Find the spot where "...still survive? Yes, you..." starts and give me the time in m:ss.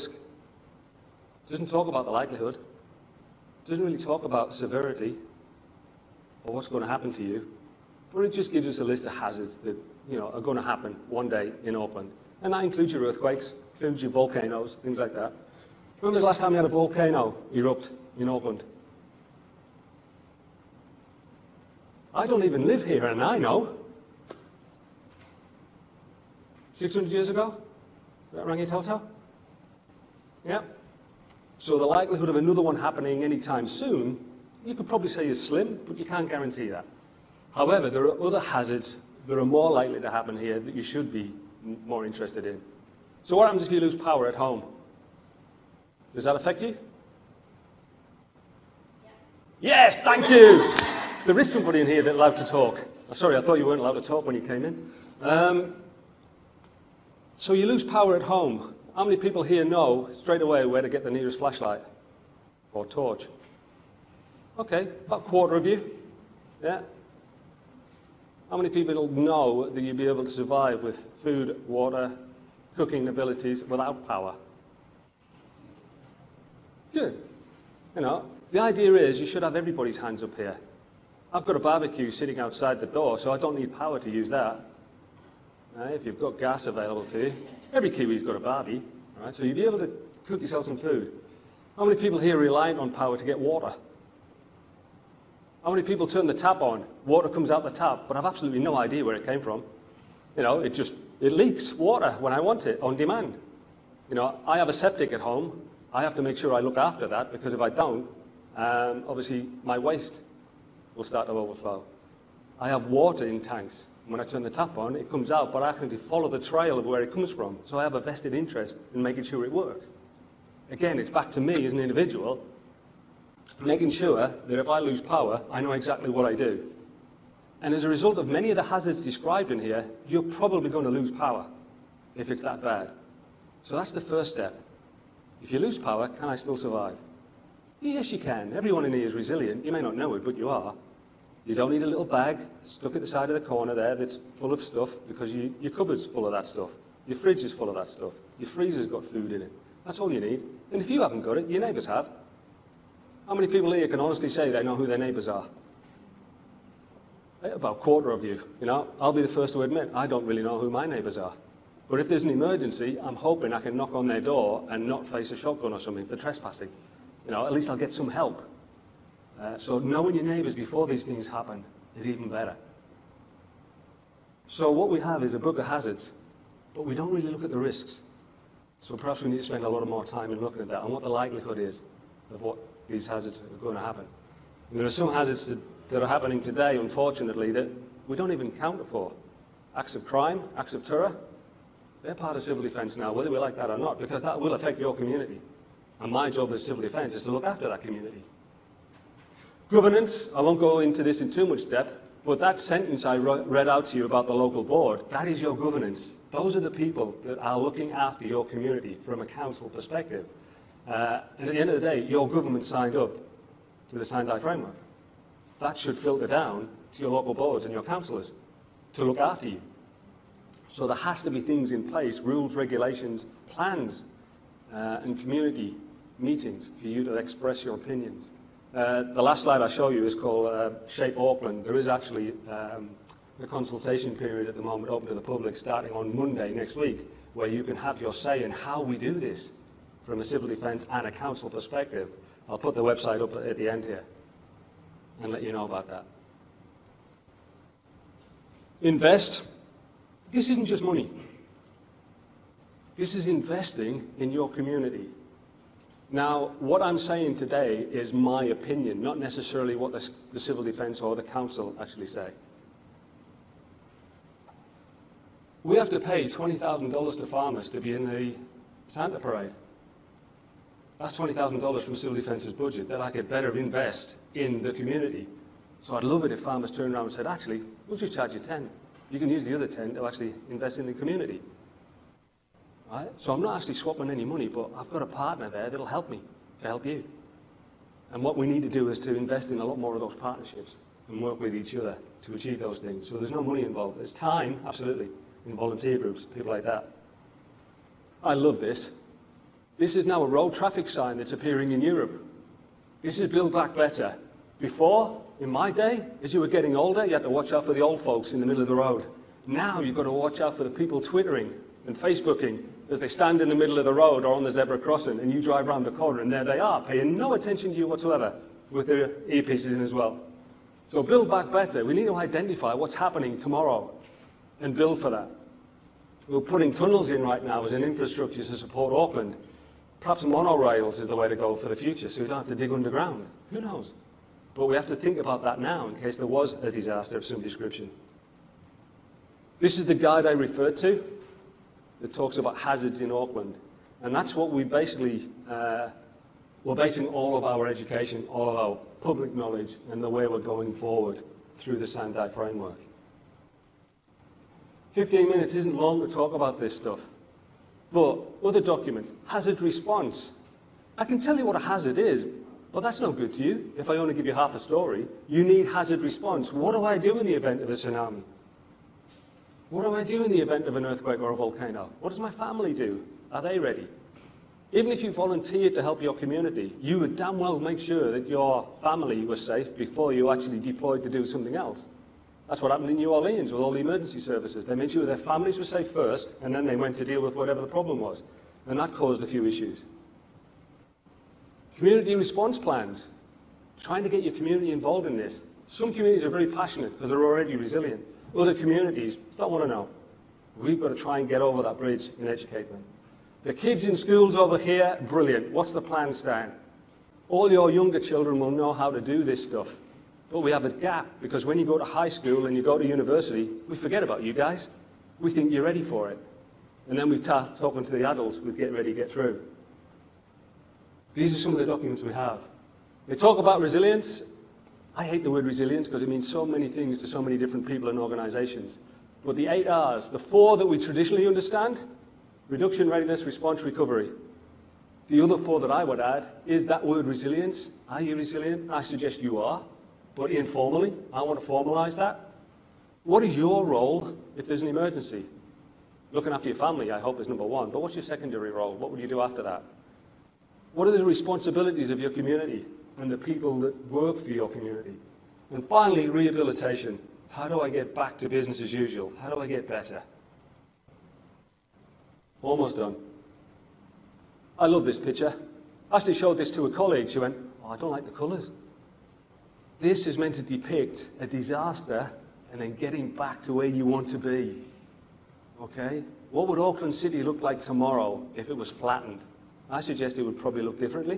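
2:16.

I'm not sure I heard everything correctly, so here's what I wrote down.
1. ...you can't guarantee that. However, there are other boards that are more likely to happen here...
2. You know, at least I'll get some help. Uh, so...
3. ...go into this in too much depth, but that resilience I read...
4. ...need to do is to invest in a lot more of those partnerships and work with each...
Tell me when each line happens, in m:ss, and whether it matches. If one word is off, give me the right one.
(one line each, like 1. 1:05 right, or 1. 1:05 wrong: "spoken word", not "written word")
1. 0:35 wrong: "hazards", not "boards"
2. 2:47 right
3. 3:20 wrong: "sentence", not "resilience"
4. 4:48 right.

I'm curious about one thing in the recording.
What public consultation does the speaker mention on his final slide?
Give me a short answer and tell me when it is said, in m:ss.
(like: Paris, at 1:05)
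Shape Auckland, at 3:50.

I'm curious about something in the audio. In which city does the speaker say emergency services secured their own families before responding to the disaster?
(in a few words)
New Orleans.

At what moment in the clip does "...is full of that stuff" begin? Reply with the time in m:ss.
2:27.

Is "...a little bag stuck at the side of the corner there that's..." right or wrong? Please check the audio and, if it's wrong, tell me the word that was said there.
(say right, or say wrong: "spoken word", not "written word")
right.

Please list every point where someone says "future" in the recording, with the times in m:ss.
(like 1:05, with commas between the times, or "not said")
5:31.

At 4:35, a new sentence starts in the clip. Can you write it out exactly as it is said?
So I'd love it if farmers turned around and said, actually, we'll just charge you 10.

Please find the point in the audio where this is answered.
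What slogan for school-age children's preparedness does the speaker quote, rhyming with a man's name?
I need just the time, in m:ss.
6:45.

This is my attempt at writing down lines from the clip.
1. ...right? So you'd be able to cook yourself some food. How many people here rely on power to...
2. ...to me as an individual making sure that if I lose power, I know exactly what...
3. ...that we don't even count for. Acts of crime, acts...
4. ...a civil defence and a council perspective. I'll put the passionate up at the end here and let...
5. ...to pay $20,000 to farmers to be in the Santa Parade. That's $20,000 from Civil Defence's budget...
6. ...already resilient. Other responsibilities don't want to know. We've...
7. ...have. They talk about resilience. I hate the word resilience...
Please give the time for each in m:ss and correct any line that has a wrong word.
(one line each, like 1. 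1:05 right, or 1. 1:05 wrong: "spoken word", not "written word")
1. 1:29 right
2. 2:01 right
3. 3:07 right
4. 4:00 wrong: "website", not "passionate"
5. 4:25 right
6. 6:37 wrong: "communities", not "responsibilities"
7. 7:02 right.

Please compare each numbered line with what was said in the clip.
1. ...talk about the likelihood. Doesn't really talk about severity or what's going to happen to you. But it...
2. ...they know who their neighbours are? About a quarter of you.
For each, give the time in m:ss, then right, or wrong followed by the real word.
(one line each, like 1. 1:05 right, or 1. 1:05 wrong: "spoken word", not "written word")
1. 0:01 right
2. 2:34 right.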